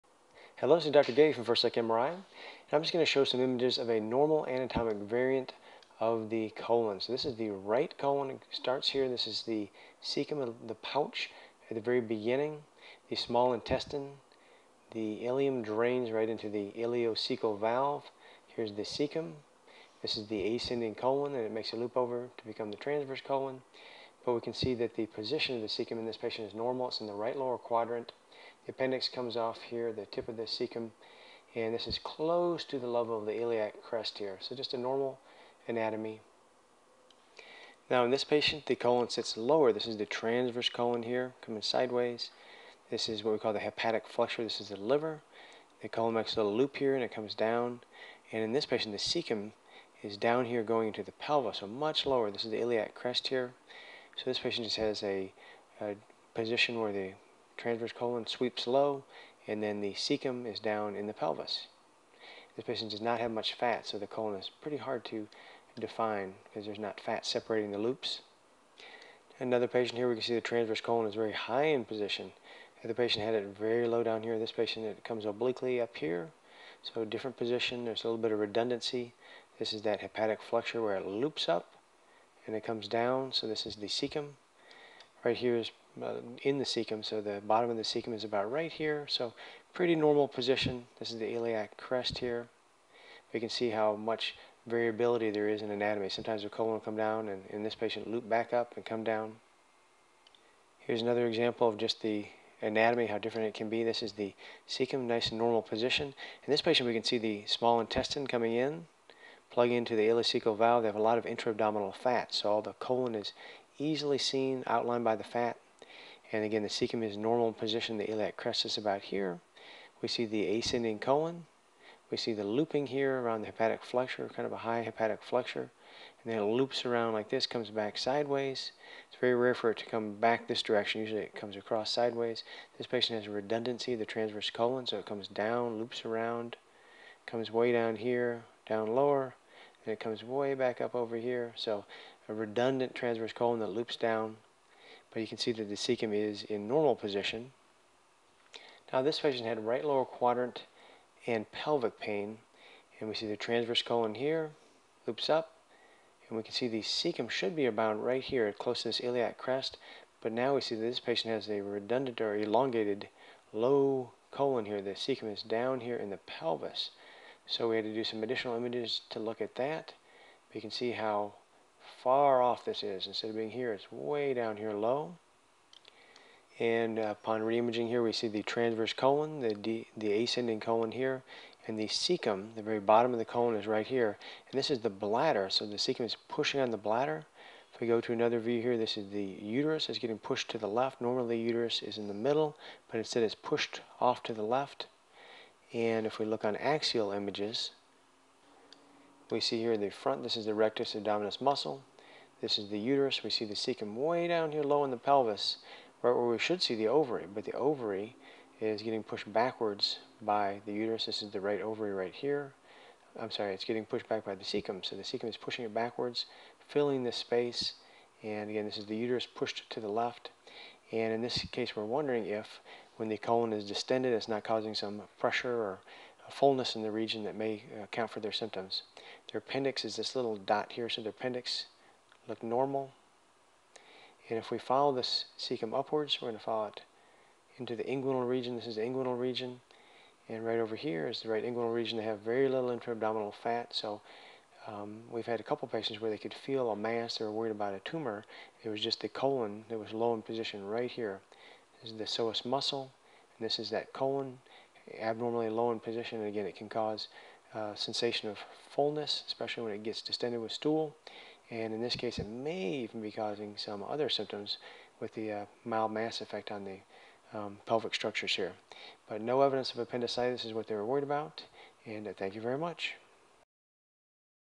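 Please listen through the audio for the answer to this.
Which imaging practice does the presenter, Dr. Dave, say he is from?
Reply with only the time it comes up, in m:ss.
0:01.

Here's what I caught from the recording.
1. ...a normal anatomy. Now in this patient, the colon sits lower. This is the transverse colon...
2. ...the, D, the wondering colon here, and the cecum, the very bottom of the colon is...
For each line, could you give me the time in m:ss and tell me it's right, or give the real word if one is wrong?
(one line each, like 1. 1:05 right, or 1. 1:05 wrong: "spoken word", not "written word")
1. 0:34 right
2. 2:59 wrong: "ascending", not "wondering".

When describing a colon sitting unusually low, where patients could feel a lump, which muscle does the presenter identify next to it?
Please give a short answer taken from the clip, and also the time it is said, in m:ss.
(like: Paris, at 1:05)
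psoas muscle, at 4:12.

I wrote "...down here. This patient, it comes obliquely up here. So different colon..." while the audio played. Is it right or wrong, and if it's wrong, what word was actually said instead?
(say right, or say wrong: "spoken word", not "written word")
wrong: "position", not "colon".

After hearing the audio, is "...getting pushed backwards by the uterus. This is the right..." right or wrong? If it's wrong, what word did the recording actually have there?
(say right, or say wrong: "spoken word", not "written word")
right.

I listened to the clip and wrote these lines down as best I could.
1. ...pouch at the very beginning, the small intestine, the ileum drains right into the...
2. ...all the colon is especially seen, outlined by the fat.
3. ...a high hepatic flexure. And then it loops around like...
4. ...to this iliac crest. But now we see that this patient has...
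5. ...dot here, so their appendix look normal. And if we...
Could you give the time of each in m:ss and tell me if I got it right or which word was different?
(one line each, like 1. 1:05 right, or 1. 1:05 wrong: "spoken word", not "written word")
1. 0:10 right
2. 1:52 wrong: "easily", not "especially"
3. 2:04 right
4. 2:38 right
5. 3:50 right.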